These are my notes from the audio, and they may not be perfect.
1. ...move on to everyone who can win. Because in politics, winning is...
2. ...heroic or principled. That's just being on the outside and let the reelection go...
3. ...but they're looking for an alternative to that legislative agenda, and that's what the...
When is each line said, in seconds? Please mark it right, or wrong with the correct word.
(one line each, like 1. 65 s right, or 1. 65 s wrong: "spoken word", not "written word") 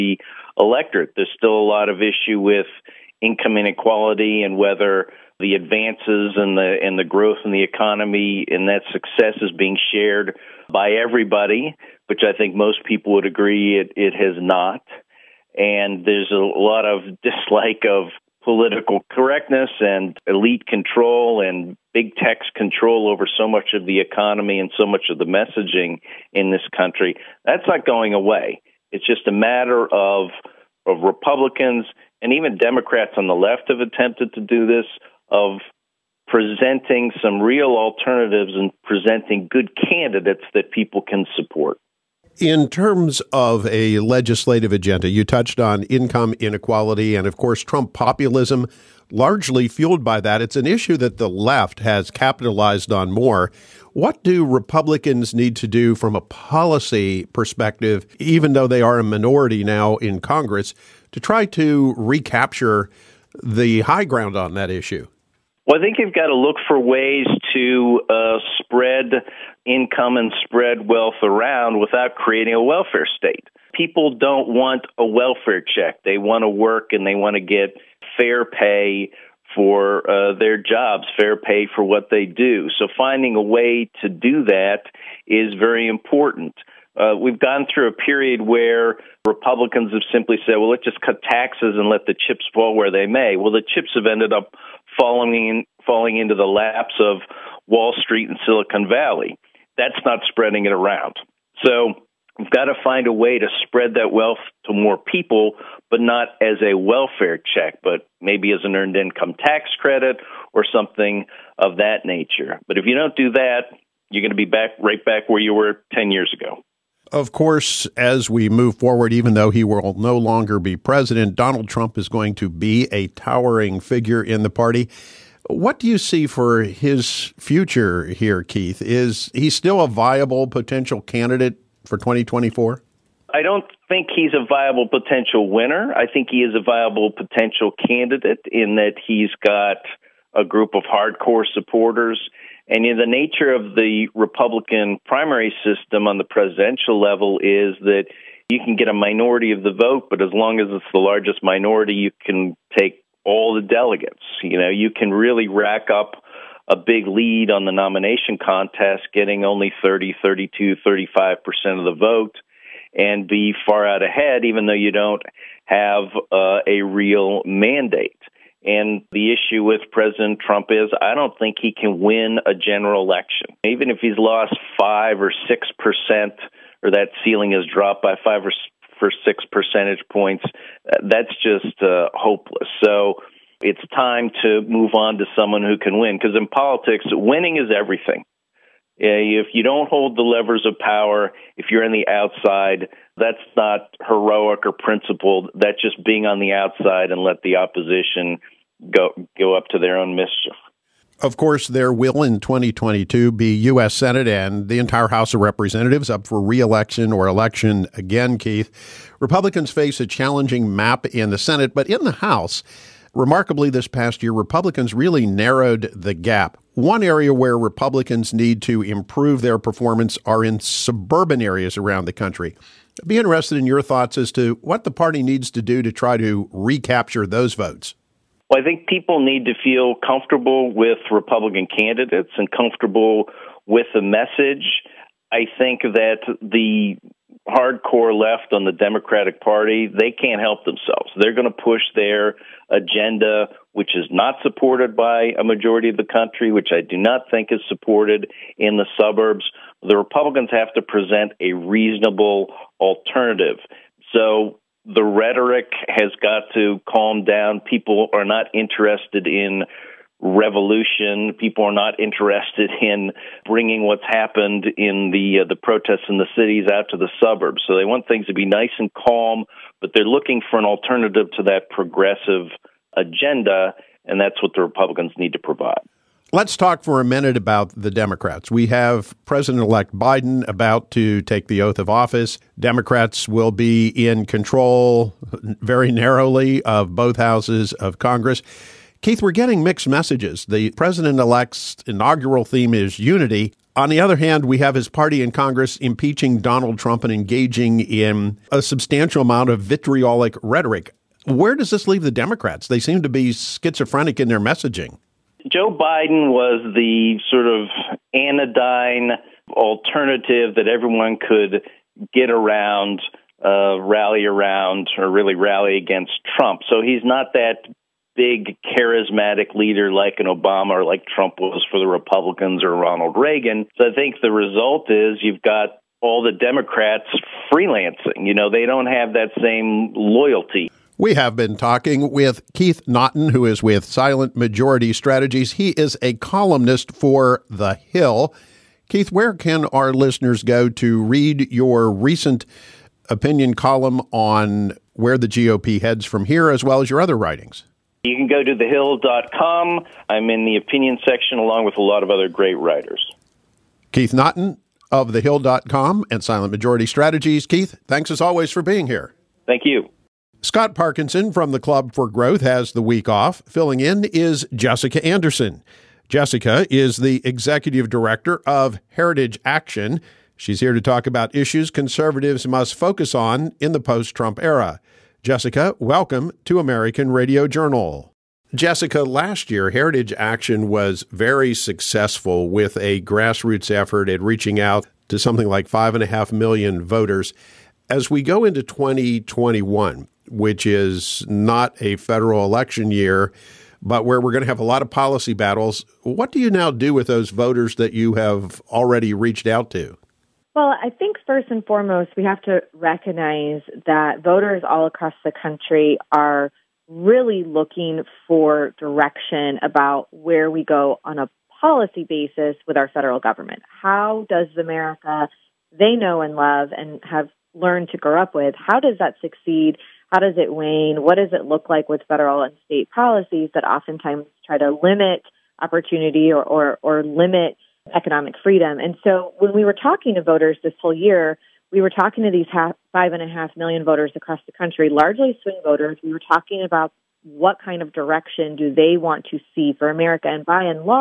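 1. 184 s wrong: "someone", not "everyone"
2. 194 s wrong: "opposition", not "reelection"
3. 269 s wrong: "progressive", not "legislative".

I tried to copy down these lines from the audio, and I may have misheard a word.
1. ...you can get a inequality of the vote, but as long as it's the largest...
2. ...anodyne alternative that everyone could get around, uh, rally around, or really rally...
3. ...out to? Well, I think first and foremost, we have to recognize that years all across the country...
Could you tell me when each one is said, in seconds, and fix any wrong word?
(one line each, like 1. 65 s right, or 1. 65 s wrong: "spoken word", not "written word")
1. 148 s wrong: "minority", not "inequality"
2. 308 s right
3. 399 s wrong: "voters", not "years".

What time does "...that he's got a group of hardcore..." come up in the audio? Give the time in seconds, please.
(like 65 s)
138 s.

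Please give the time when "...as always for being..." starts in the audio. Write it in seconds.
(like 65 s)
358 s.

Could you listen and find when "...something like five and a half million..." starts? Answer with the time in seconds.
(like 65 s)
385 s.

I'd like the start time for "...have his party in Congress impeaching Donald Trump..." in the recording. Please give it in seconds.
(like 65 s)
294 s.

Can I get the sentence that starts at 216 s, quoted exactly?
One area where Republicans need to improve their performance are in suburban areas around the country.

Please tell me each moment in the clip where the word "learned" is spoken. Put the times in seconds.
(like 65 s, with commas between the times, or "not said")
417 s.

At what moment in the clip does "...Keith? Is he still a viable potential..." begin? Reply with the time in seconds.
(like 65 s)
128 s.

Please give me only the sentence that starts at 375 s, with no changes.
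Jessica, welcome to American Radio Journal.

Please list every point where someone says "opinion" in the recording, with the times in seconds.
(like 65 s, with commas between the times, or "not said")
343 s, 350 s.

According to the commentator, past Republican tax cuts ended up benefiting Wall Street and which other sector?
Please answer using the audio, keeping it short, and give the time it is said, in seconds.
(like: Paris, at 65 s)
Silicon Valley, at 98 s.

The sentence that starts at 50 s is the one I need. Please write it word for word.
It's an issue that the left has capitalized on more.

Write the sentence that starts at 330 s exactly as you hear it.
We have been talking with Keith Naughton, who is with Silent Majority Strategies.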